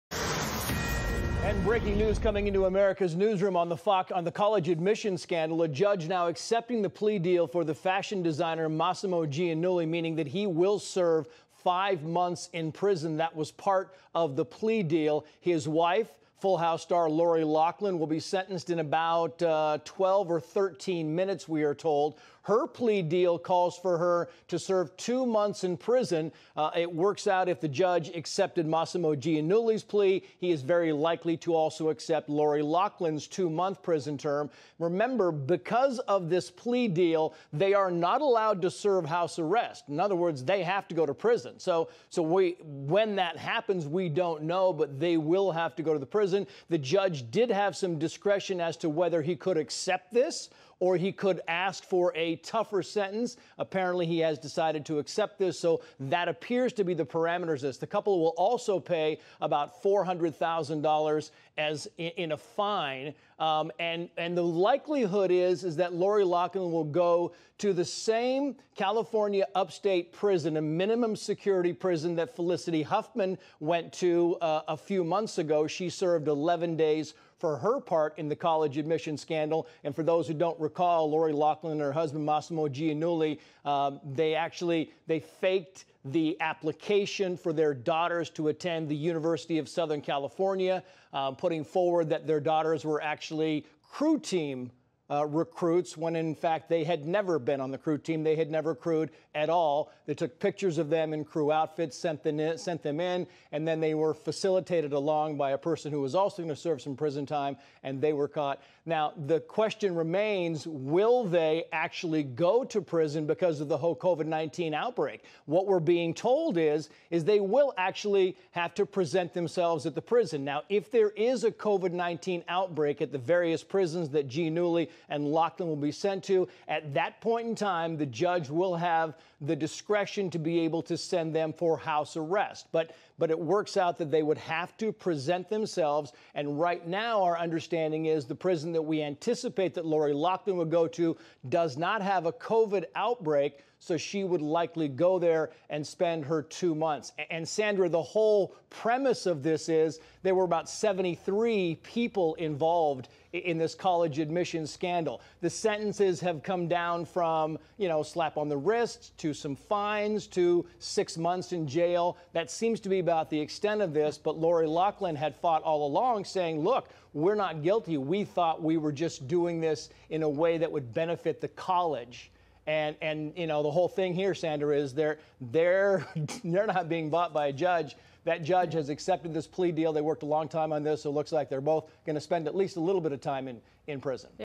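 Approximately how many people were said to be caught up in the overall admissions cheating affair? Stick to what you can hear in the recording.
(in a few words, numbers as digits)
73.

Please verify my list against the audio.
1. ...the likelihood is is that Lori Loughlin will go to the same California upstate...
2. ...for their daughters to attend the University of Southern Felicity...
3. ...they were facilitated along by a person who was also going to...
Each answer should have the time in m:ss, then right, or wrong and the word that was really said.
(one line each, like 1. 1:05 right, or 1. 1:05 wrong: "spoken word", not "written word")
1. 1:04 right
2. 1:27 wrong: "California", not "Felicity"
3. 1:43 right.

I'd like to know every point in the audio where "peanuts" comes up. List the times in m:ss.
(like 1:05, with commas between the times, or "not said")
not said.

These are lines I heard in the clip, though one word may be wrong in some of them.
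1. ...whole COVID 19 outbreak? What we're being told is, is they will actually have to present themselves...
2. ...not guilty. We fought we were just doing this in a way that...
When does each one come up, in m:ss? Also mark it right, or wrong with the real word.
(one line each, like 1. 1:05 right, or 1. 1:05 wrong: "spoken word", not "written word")
1. 1:53 right
2. 2:47 wrong: "thought", not "fought".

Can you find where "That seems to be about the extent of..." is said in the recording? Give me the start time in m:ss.
2:42.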